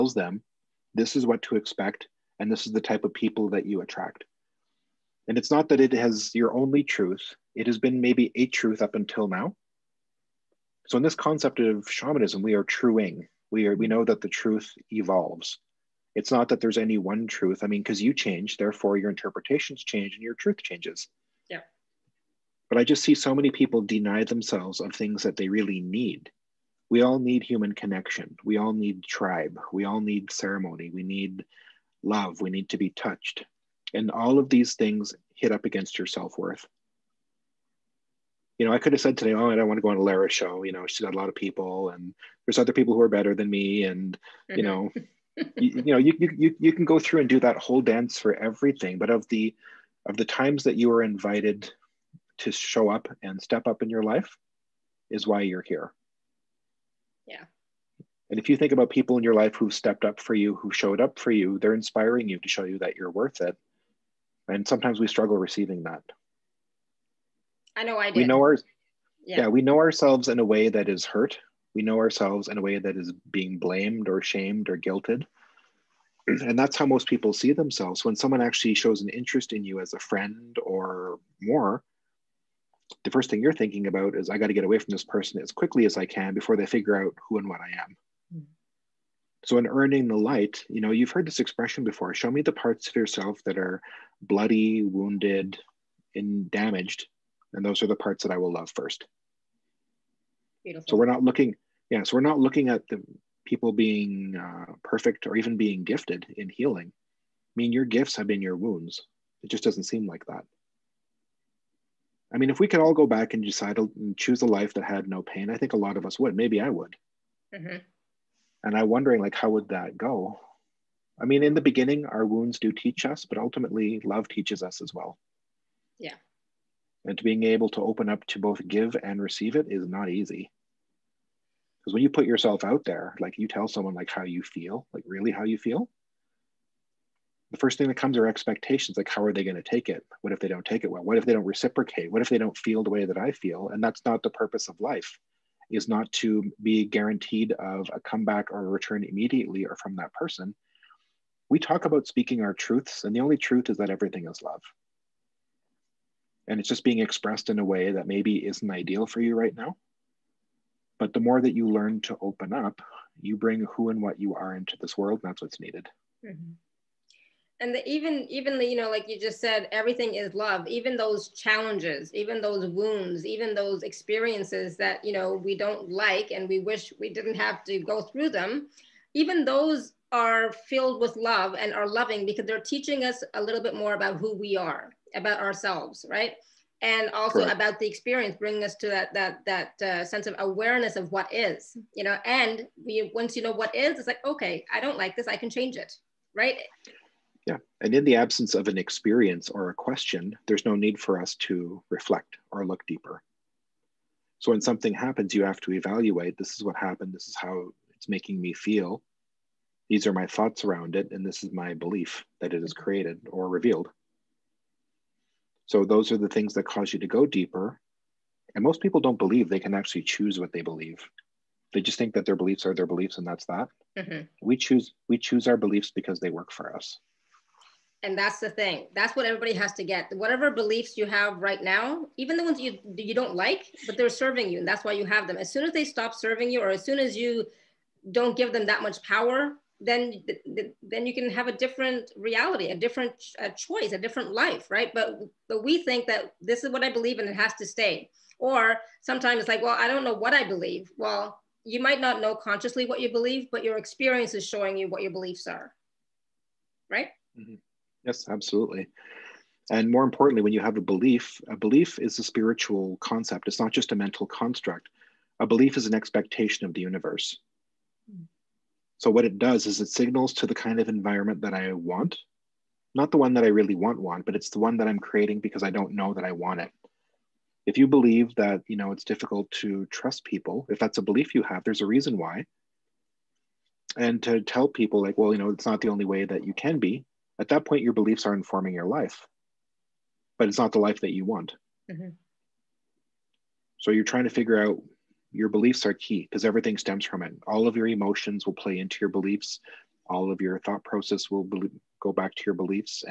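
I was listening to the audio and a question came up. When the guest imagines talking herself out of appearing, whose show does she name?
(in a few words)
Alara.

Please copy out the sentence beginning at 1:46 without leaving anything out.
I mean, your gifts have been your wounds.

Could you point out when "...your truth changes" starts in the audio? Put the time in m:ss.
0:20.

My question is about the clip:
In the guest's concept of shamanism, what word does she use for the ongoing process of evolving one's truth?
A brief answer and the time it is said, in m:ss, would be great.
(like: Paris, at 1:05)
truing, at 0:12.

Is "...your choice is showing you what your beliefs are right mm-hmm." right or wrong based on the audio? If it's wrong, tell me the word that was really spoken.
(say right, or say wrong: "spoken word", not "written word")
wrong: "experience", not "choice".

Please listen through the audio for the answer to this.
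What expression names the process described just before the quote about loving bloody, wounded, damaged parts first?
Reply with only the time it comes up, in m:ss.
1:29.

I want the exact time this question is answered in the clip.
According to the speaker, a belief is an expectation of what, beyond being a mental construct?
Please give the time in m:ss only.
4:26.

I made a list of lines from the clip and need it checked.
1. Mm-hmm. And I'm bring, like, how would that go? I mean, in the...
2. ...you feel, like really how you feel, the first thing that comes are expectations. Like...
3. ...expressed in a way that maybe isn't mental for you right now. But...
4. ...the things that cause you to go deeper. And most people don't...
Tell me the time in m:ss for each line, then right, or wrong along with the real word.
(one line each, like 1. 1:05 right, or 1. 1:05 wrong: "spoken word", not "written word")
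1. 1:57 wrong: "wondering", not "bring"
2. 2:14 right
3. 2:36 wrong: "ideal", not "mental"
4. 3:36 right.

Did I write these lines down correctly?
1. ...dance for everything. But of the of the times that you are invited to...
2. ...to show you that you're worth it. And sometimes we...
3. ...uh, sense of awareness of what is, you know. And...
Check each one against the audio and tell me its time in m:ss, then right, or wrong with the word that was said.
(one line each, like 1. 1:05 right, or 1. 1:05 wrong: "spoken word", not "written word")
1. 0:47 right
2. 1:02 right
3. 3:09 right.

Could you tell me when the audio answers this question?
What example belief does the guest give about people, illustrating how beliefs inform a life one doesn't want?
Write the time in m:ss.
4:39.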